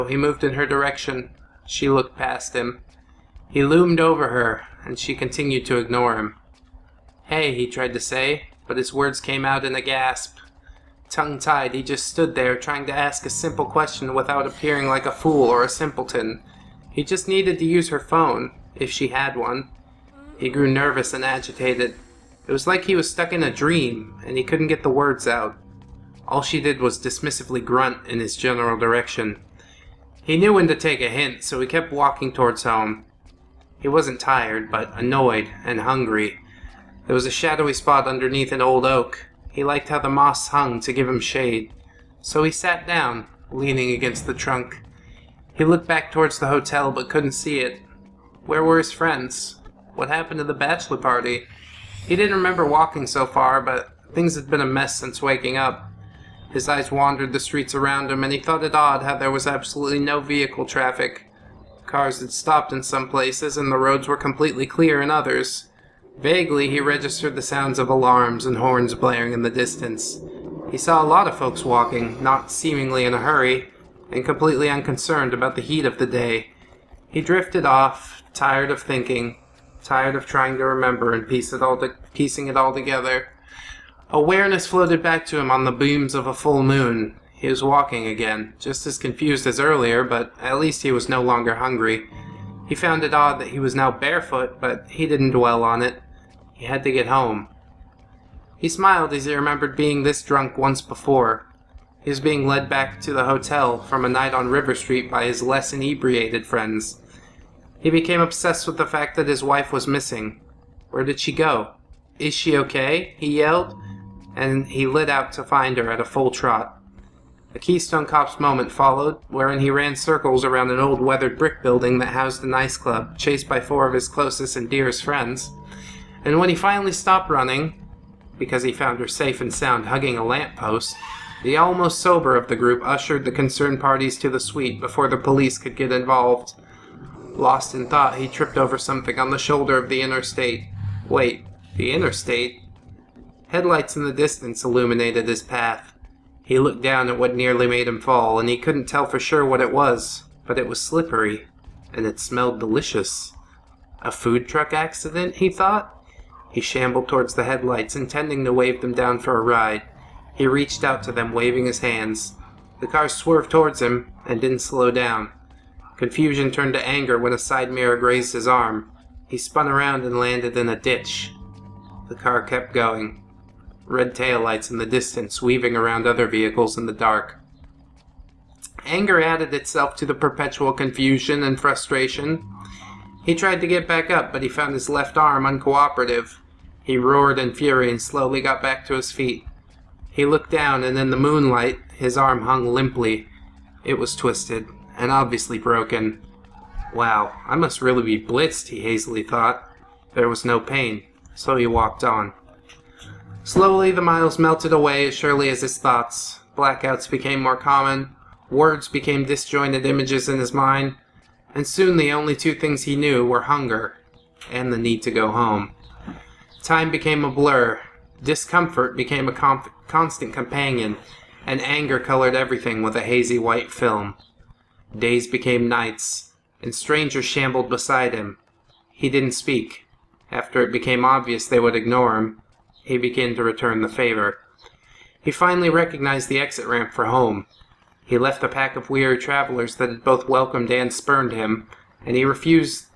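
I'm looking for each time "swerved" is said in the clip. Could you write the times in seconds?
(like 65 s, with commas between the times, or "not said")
163 s.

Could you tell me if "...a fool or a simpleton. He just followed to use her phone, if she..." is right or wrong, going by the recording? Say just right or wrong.
wrong.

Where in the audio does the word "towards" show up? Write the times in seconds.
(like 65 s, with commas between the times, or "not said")
32 s, 46 s, 157 s, 163 s.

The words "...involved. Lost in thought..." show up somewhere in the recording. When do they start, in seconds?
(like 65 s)
135 s.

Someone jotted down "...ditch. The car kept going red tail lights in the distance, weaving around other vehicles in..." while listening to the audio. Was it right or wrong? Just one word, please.
right.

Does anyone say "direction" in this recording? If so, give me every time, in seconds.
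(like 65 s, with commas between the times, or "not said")
0 s, 28 s.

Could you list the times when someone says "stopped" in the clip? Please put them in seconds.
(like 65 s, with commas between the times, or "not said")
62 s, 126 s.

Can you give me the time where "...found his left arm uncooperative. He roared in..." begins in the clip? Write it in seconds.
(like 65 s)
184 s.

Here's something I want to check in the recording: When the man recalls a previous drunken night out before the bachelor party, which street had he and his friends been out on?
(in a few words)
River Street.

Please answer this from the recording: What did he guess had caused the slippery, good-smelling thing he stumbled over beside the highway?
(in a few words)
A food truck accident.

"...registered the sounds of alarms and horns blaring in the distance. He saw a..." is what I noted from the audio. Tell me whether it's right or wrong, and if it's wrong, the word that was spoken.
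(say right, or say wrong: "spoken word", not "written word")
right.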